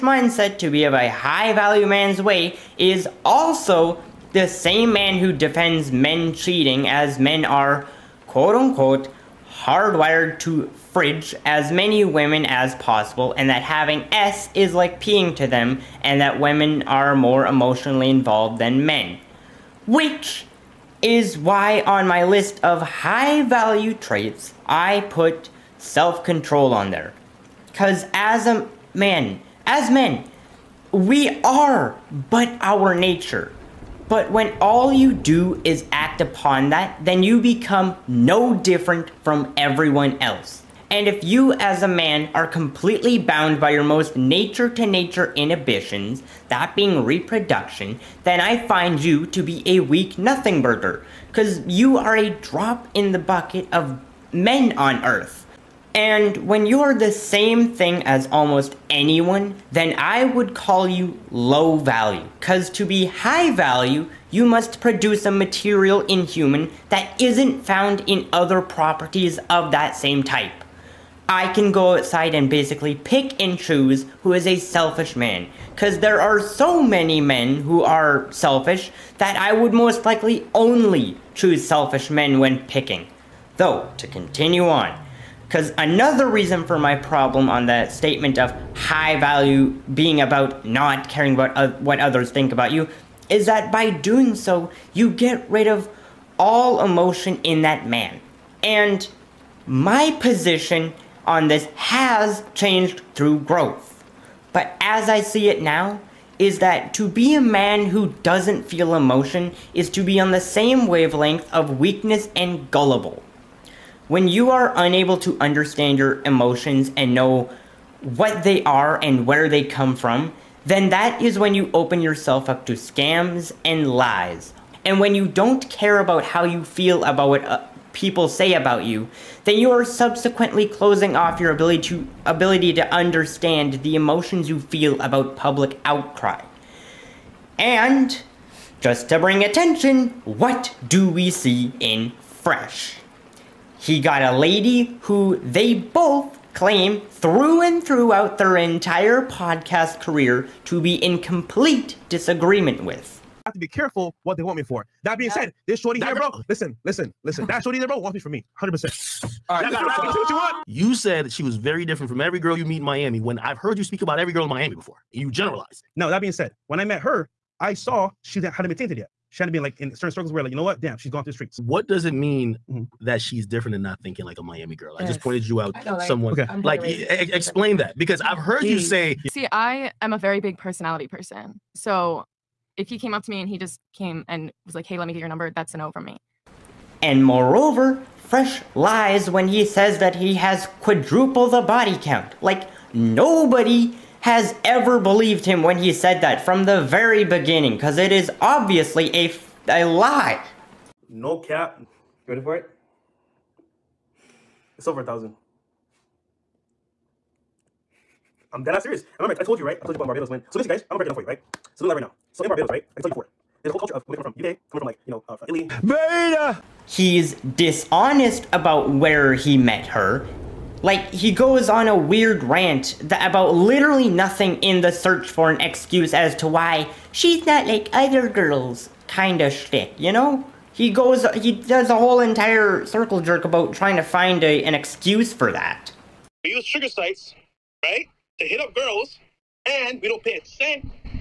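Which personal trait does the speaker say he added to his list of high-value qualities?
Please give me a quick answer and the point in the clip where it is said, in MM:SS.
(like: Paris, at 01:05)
Self control, at 00:25.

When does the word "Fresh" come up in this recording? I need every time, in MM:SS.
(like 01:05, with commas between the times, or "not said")
02:22, 03:08.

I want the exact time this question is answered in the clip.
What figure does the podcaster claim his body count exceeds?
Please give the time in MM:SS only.
03:25.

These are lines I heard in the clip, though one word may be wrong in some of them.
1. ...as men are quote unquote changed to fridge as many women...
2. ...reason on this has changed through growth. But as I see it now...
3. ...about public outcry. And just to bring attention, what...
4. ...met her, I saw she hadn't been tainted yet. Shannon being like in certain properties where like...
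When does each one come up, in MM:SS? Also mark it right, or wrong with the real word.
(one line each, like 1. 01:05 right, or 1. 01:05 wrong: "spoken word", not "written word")
1. 00:06 wrong: "hardwired", not "changed"
2. 01:40 wrong: "position", not "reason"
3. 02:15 right
4. 02:46 wrong: "circles", not "properties".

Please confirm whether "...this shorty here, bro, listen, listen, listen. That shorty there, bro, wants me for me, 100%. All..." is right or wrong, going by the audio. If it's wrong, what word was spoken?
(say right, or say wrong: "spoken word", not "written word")
right.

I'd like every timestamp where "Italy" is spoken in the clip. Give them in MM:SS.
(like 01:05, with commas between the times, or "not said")
03:35.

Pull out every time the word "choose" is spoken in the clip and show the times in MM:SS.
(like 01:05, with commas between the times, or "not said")
01:13, 01:21.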